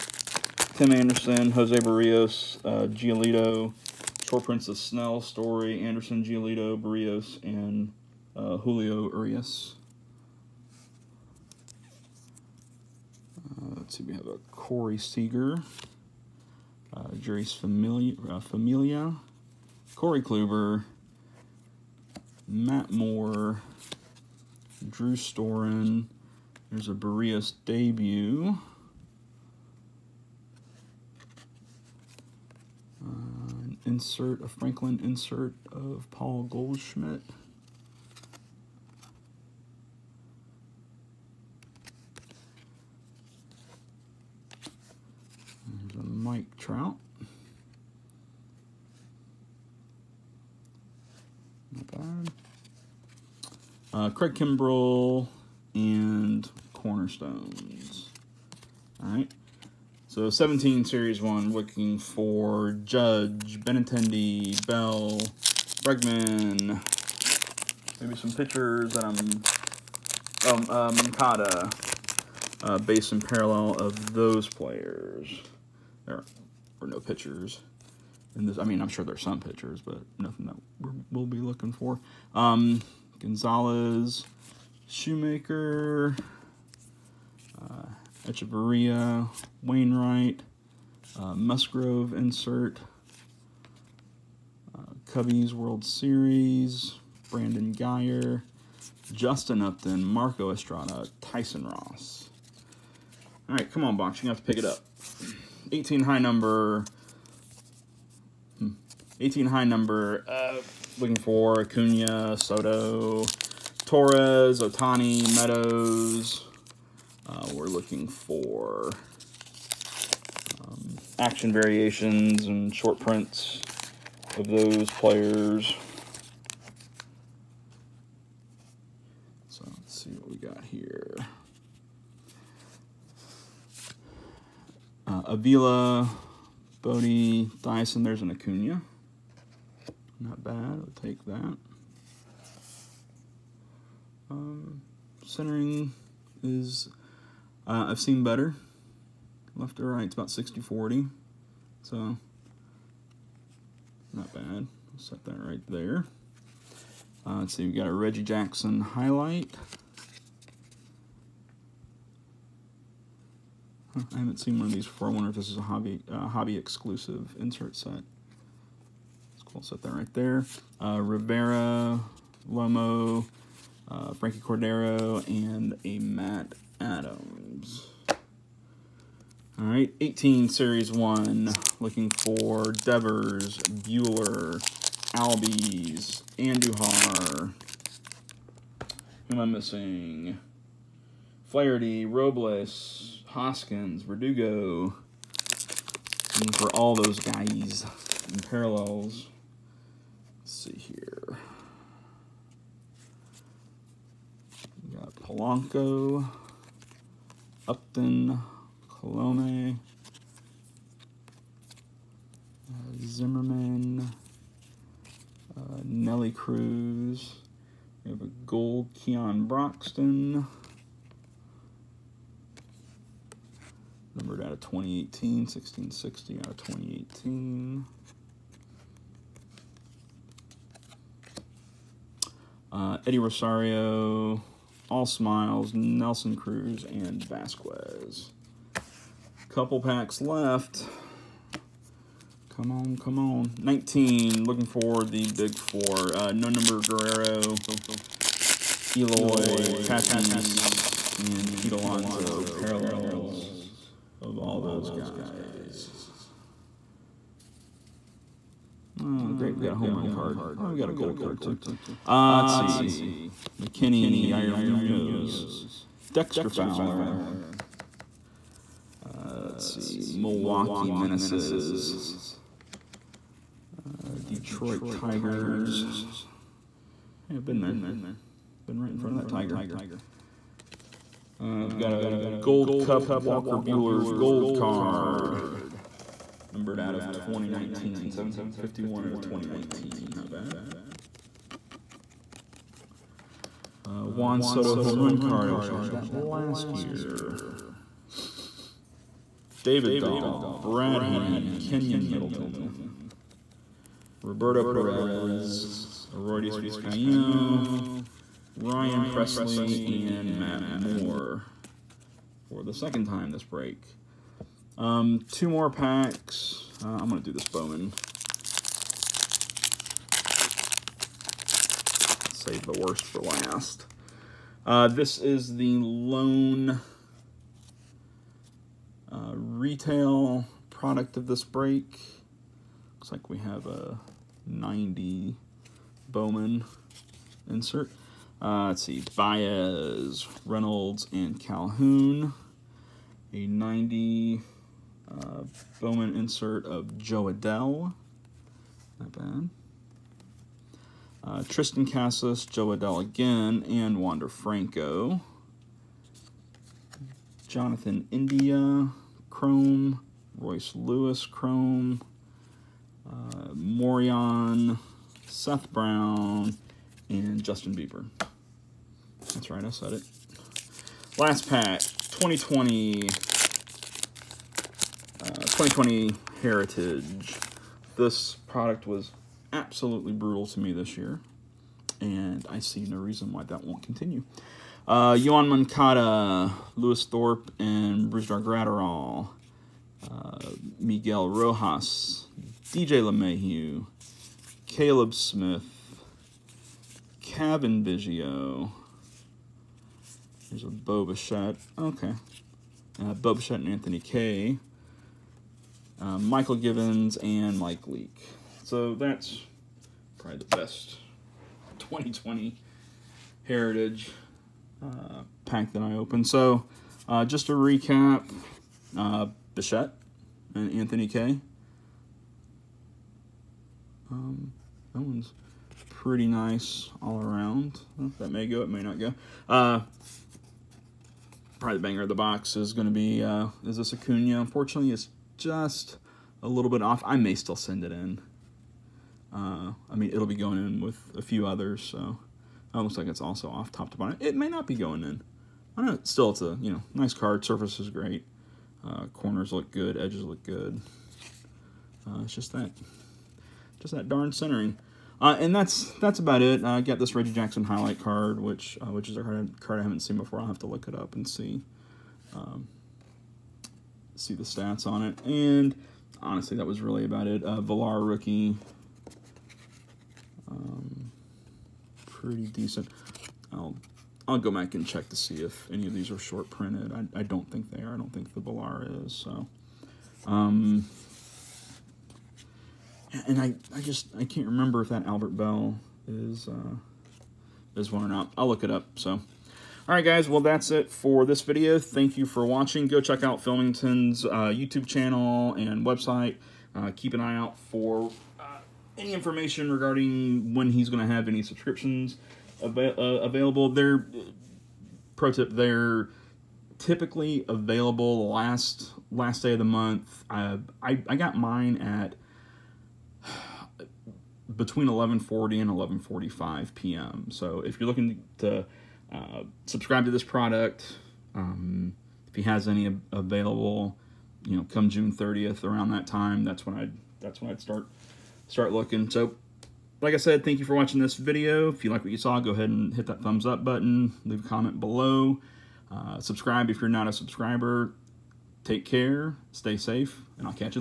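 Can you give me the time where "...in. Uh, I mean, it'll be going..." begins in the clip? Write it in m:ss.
7:17.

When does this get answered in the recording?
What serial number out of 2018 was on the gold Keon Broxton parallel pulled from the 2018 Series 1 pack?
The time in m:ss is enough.
3:45.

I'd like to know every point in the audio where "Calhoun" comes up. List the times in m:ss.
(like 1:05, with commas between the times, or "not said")
5:41.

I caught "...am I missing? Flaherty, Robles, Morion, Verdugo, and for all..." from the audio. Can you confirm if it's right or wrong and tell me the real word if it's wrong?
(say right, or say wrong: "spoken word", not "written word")
wrong: "Hoskins", not "Morion".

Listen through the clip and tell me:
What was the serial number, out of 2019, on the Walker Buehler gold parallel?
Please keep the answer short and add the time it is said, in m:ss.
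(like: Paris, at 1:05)
1751, at 4:48.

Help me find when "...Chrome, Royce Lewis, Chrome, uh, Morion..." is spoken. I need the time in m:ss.
5:59.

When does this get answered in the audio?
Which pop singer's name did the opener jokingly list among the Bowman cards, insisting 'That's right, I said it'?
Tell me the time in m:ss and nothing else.
6:07.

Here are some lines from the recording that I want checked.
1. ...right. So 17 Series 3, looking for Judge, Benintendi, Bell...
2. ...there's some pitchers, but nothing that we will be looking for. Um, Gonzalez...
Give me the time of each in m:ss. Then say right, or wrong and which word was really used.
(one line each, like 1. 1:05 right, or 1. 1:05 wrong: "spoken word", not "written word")
1. 0:59 wrong: "1", not "3"
2. 1:19 right.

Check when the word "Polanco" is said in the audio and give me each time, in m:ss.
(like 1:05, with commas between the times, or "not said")
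3:25.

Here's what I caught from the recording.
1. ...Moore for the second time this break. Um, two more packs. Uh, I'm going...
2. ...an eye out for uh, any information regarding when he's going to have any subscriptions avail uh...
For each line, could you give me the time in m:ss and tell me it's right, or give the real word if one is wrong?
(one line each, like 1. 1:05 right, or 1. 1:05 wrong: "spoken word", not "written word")
1. 5:10 right
2. 8:17 right.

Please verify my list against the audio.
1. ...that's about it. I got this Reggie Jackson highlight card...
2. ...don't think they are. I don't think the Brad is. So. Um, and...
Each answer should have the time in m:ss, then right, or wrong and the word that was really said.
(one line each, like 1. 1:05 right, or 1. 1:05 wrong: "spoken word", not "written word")
1. 7:35 right
2. 7:57 wrong: "Villar", not "Brad".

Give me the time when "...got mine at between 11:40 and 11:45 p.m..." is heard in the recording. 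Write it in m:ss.
8:31.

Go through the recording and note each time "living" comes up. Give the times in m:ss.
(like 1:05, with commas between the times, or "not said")
not said.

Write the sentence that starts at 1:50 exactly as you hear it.
Uh, looking for Acuna, Soto, Torres, Ohtani, Meadows.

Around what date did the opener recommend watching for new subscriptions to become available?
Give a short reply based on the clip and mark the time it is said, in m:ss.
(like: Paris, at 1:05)
June 30th, at 8:44.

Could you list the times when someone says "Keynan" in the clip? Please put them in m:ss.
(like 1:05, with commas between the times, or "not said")
5:01.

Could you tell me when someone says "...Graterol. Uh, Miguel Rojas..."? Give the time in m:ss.
6:28.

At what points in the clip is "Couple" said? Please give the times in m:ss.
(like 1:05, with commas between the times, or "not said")
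3:59.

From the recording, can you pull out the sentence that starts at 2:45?
I wonder if this is a hobby uh, hobby exclusive insert set.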